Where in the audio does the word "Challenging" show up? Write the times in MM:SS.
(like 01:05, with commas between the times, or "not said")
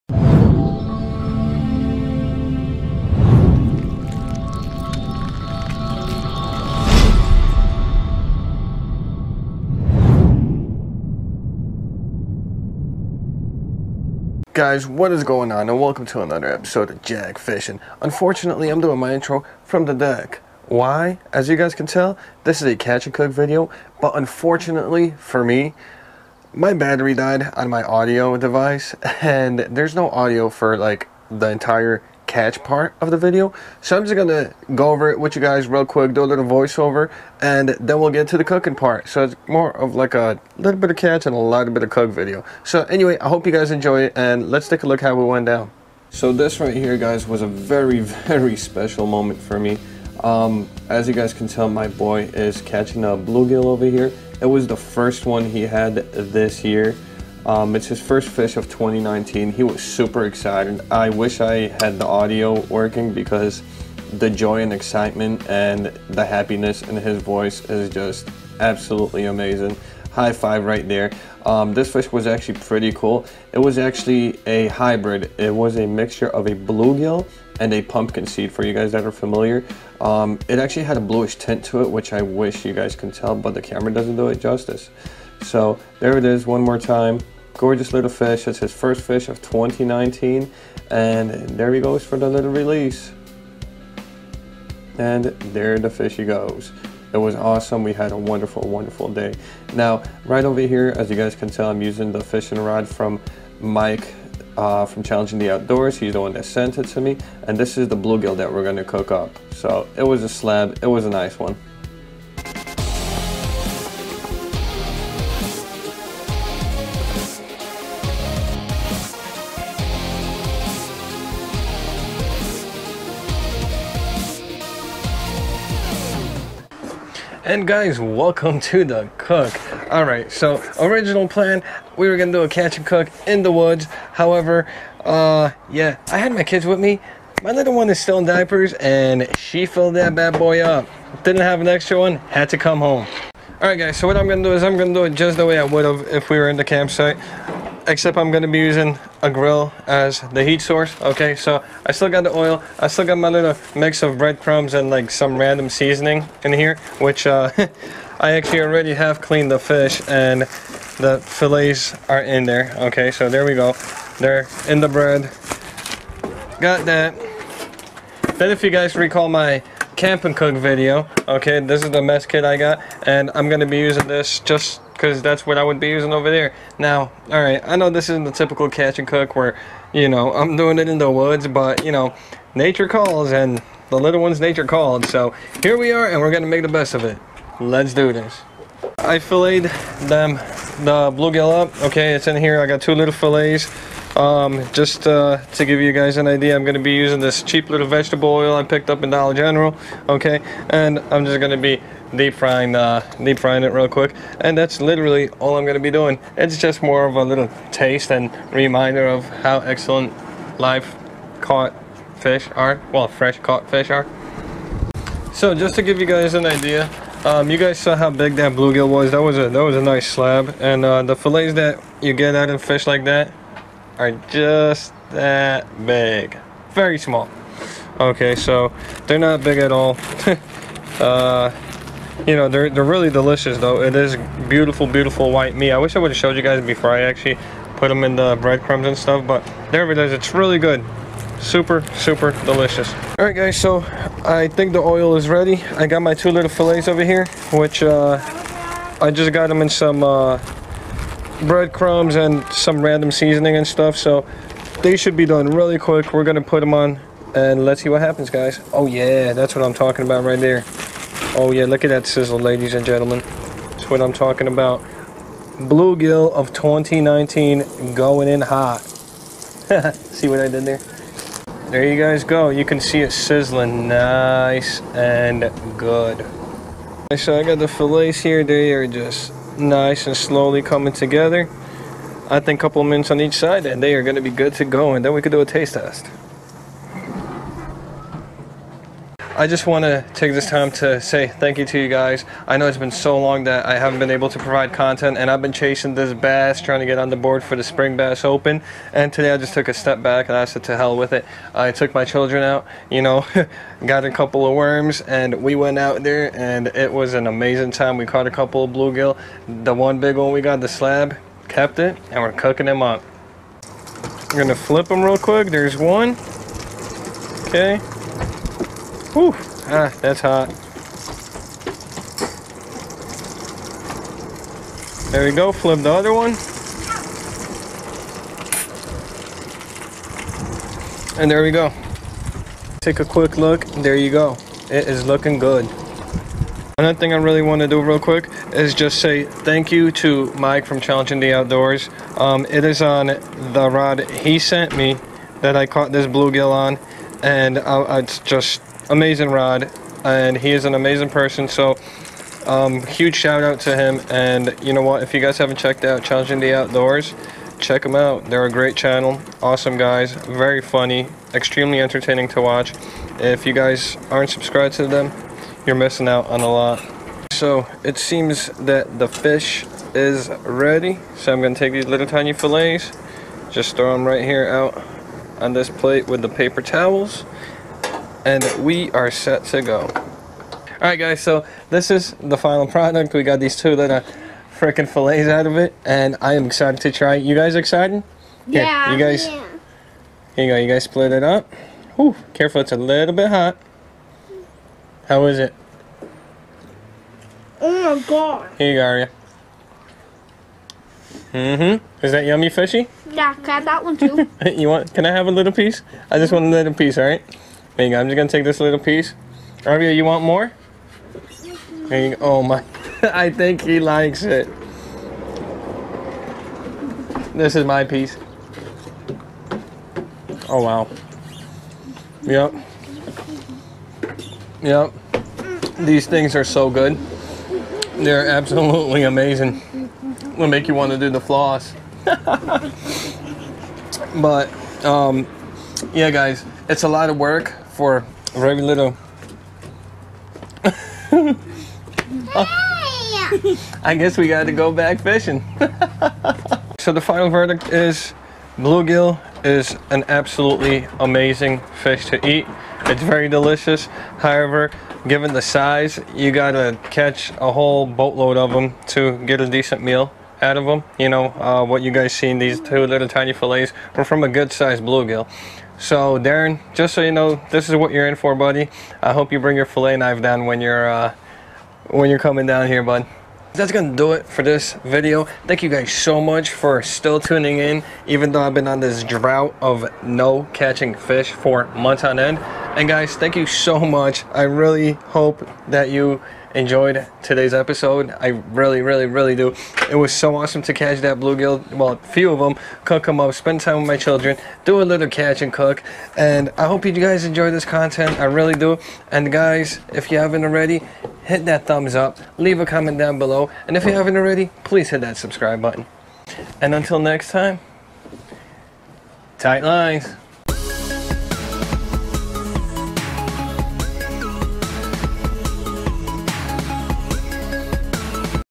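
01:45, 05:40, 05:56.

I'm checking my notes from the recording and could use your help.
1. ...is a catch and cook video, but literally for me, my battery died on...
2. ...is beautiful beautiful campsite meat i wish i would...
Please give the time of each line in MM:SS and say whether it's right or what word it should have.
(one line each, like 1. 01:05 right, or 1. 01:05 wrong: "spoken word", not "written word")
1. 00:22 wrong: "unfortunately", not "literally"
2. 03:53 wrong: "white", not "campsite".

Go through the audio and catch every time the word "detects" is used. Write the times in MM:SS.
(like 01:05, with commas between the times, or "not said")
not said.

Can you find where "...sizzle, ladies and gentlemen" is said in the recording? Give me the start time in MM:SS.
04:22.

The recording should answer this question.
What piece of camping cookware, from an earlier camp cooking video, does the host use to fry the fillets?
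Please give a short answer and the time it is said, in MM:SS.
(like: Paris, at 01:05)
Mess kit, at 02:52.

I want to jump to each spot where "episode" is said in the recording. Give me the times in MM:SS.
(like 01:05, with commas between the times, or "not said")
00:16, 08:07.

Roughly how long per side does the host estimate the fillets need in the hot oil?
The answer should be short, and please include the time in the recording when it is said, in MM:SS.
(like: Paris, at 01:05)
A couple minutes, at 04:42.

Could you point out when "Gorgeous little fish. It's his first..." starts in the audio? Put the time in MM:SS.
01:27.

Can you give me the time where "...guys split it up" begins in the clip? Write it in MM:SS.
06:30.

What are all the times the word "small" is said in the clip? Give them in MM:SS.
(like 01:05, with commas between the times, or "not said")
03:46.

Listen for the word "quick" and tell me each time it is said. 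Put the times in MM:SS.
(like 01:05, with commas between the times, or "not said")
00:35, 03:23, 04:15, 05:15, 05:33, 05:37.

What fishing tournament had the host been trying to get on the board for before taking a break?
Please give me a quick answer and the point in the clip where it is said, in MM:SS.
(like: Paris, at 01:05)
Spring Bass Open, at 04:57.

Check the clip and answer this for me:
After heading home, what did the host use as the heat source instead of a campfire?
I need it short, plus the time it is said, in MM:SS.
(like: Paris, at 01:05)
A grill, at 02:29.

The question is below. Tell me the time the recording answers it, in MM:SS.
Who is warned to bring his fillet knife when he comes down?
07:46.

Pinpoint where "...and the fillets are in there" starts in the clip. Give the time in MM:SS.
02:40.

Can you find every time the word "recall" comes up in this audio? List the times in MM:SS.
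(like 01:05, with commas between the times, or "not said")
02:48.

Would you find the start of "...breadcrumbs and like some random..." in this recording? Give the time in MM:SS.
02:34.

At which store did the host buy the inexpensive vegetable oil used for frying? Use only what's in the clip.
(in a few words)
Dollar General.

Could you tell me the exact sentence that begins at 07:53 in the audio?
That's gonna do it for this video.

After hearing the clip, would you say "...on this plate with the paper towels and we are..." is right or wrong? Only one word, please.
right.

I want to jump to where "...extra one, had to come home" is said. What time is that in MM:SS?
02:21.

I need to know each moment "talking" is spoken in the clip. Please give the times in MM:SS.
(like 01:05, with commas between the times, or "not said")
04:19, 04:24.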